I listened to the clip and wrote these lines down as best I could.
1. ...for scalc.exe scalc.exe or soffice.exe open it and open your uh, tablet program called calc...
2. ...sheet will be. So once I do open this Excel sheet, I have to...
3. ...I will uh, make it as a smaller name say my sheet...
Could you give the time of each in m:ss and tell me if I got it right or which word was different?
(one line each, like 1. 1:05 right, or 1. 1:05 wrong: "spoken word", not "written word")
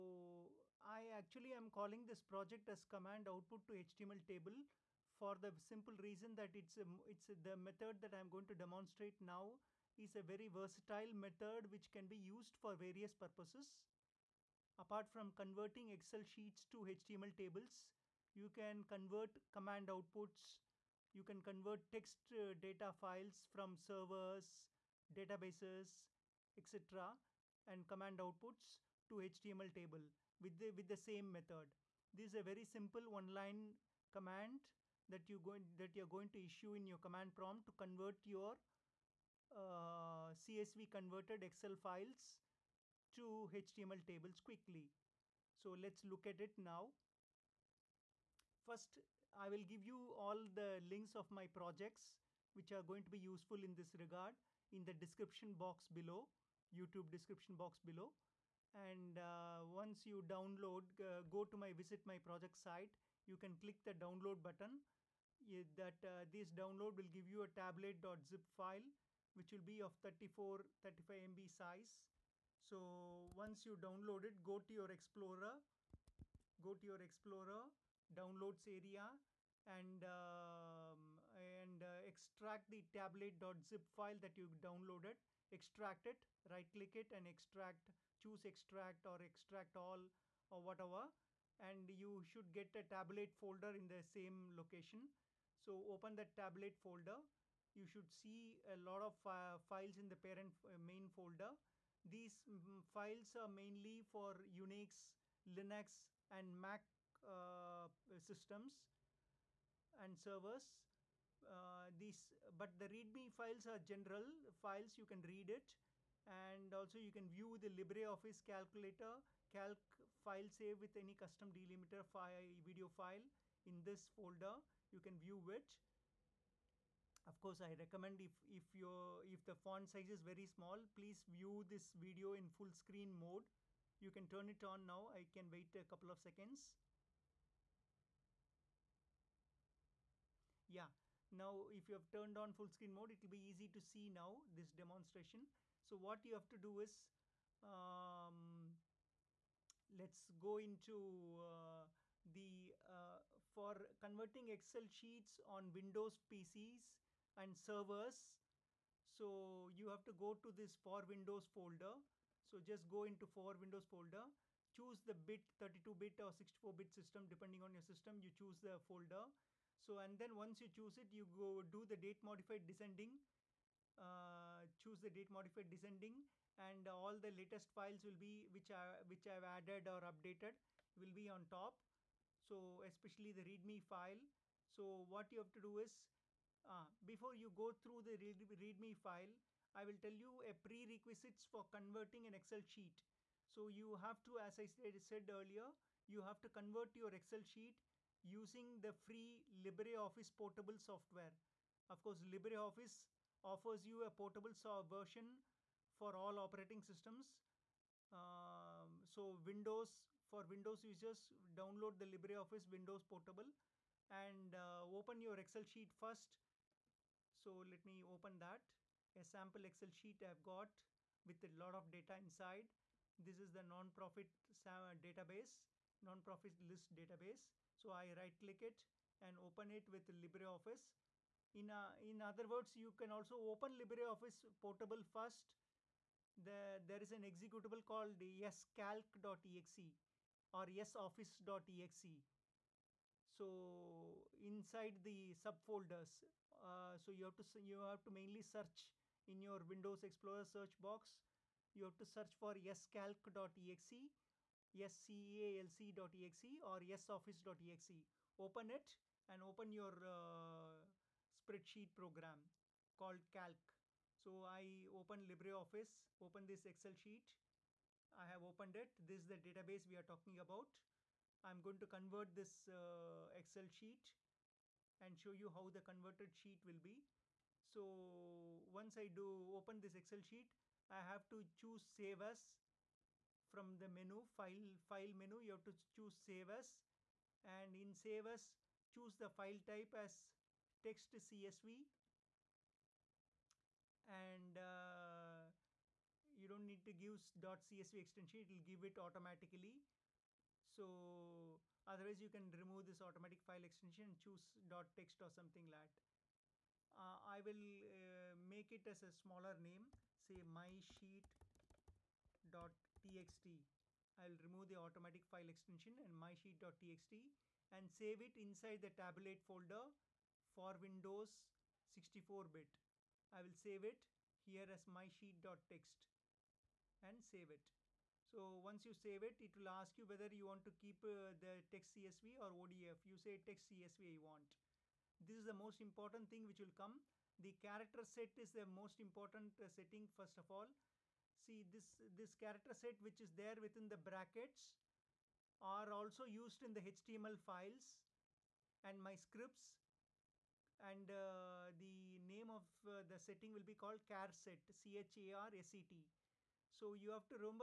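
1. 4:12 wrong: "spreadsheet", not "tablet"
2. 4:36 right
3. 5:07 right.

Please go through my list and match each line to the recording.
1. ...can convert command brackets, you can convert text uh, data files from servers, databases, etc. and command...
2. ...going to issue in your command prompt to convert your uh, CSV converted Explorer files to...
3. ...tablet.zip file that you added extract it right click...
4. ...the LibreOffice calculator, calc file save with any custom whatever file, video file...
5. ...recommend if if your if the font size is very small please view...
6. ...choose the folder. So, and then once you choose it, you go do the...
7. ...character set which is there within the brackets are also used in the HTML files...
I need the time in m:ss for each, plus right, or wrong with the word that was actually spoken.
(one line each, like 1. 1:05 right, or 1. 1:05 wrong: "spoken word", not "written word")
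1. 0:18 wrong: "outputs", not "brackets"
2. 0:36 wrong: "Excel", not "Explorer"
3. 1:22 wrong: "downloaded", not "added"
4. 1:57 wrong: "delimiter", not "whatever"
5. 2:07 right
6. 2:48 right
7. 5:42 right.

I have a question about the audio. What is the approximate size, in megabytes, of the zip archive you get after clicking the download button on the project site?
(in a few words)
34-35 MB.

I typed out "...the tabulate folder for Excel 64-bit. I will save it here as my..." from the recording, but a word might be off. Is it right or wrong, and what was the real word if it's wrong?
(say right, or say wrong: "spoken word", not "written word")
wrong: "Windows", not "Excel".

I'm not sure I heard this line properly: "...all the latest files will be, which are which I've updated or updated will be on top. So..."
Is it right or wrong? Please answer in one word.
wrong.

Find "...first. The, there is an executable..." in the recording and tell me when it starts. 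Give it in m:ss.
3:55.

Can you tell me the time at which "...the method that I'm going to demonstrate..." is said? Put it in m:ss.
0:07.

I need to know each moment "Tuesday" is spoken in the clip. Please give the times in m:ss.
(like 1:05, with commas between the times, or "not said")
not said.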